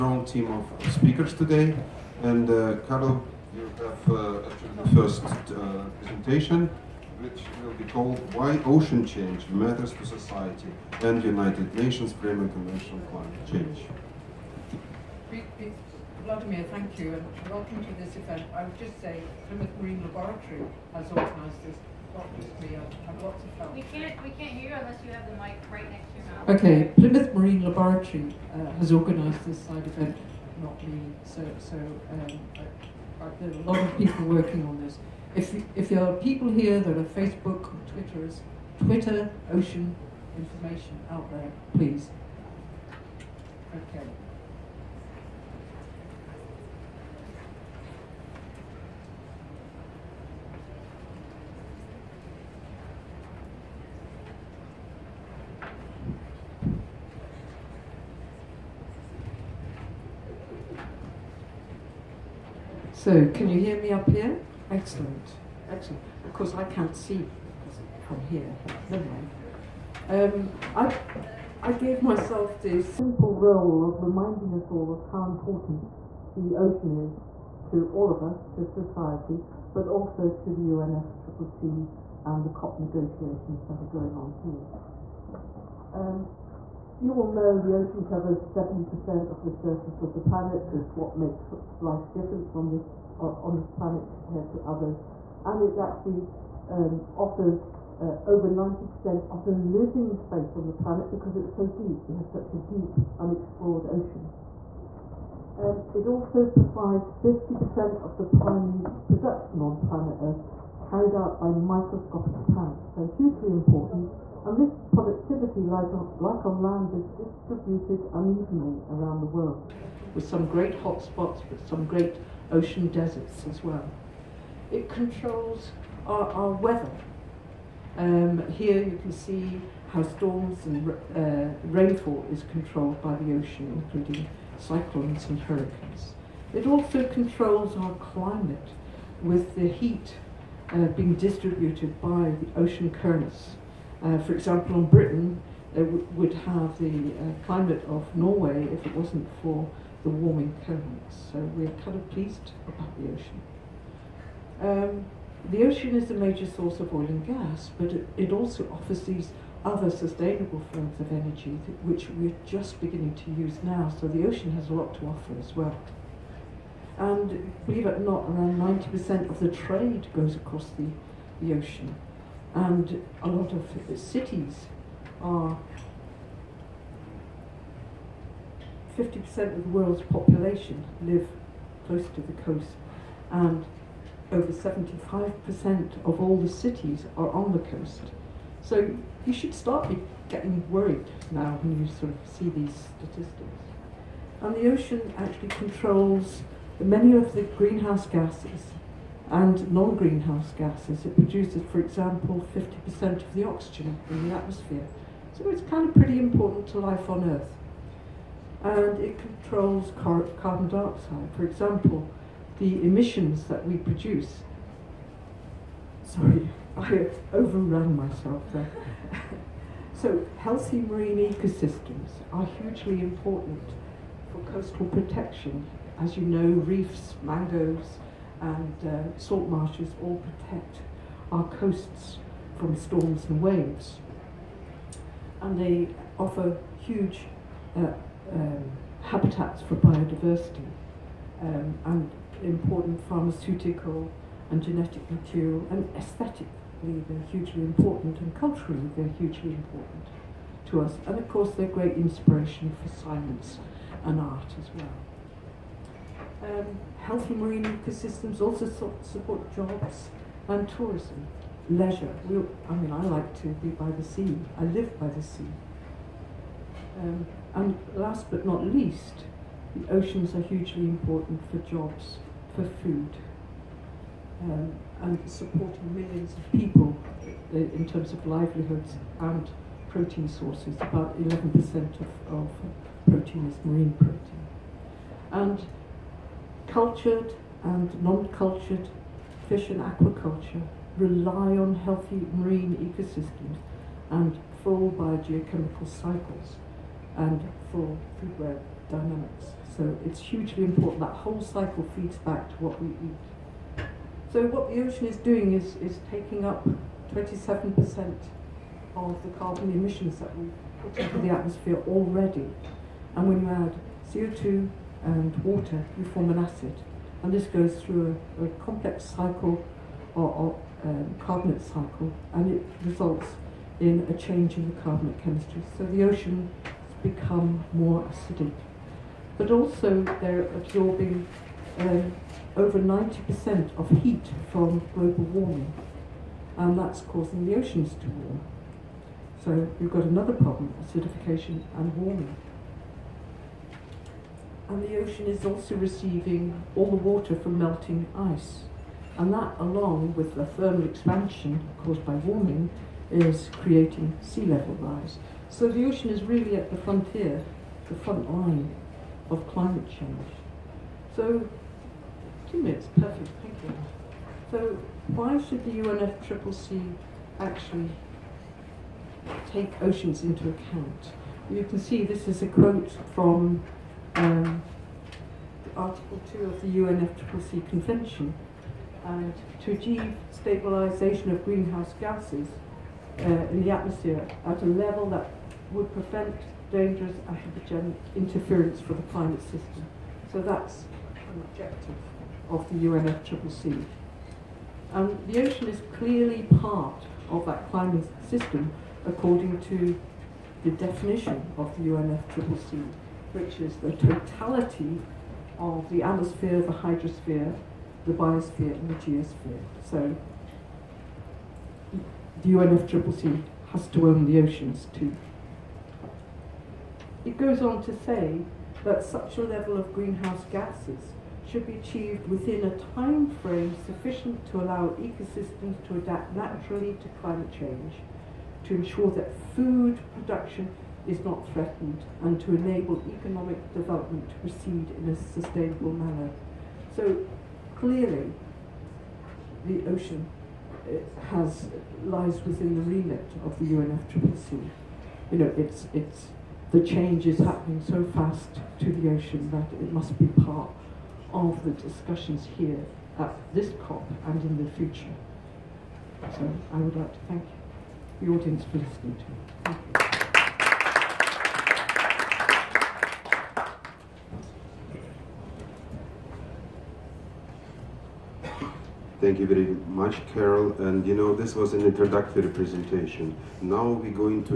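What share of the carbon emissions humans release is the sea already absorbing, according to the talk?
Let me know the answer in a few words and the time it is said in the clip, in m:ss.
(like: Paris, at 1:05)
27%, at 5:07.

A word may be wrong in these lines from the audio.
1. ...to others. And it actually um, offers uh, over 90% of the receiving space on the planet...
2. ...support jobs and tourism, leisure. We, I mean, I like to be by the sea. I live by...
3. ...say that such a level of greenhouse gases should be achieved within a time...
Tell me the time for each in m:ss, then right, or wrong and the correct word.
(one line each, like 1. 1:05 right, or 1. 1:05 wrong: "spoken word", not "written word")
1. 1:34 wrong: "living", not "receiving"
2. 4:19 right
3. 6:58 right.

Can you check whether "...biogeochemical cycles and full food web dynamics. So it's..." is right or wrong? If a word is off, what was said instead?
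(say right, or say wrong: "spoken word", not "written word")
right.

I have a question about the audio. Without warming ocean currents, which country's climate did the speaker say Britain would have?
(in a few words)
Norway.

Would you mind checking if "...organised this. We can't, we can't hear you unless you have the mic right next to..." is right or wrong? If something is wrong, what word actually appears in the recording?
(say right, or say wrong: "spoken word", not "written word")
right.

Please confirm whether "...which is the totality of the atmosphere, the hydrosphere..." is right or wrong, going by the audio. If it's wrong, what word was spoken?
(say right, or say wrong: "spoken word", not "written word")
right.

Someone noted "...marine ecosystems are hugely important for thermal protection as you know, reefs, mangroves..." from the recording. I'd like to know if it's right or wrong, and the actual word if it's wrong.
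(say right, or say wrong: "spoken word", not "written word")
wrong: "coastal", not "thermal".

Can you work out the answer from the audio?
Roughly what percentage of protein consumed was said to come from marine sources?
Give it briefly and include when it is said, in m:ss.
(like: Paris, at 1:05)
11%, at 4:41.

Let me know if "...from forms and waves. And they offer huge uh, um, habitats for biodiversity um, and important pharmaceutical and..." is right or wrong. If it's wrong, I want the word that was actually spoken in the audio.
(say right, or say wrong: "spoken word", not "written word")
wrong: "storms", not "forms".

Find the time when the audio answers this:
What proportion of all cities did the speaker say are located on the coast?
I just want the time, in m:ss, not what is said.
3:04.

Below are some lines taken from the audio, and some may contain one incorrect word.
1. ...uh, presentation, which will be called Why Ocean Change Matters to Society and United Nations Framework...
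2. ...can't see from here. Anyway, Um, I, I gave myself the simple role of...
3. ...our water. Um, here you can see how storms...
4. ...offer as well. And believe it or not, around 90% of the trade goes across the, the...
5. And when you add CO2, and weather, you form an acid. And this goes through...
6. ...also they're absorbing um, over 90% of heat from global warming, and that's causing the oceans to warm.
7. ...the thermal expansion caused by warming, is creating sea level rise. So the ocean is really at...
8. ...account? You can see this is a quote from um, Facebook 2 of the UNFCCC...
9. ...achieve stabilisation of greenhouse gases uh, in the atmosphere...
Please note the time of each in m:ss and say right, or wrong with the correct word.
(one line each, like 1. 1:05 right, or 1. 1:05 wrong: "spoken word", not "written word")
1. 0:05 right
2. 1:06 right
3. 2:06 wrong: "weather", not "water"
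4. 2:45 right
5. 5:13 wrong: "water", not "weather"
6. 5:29 right
7. 5:50 right
8. 6:10 wrong: "Article", not "Facebook"
9. 6:19 right.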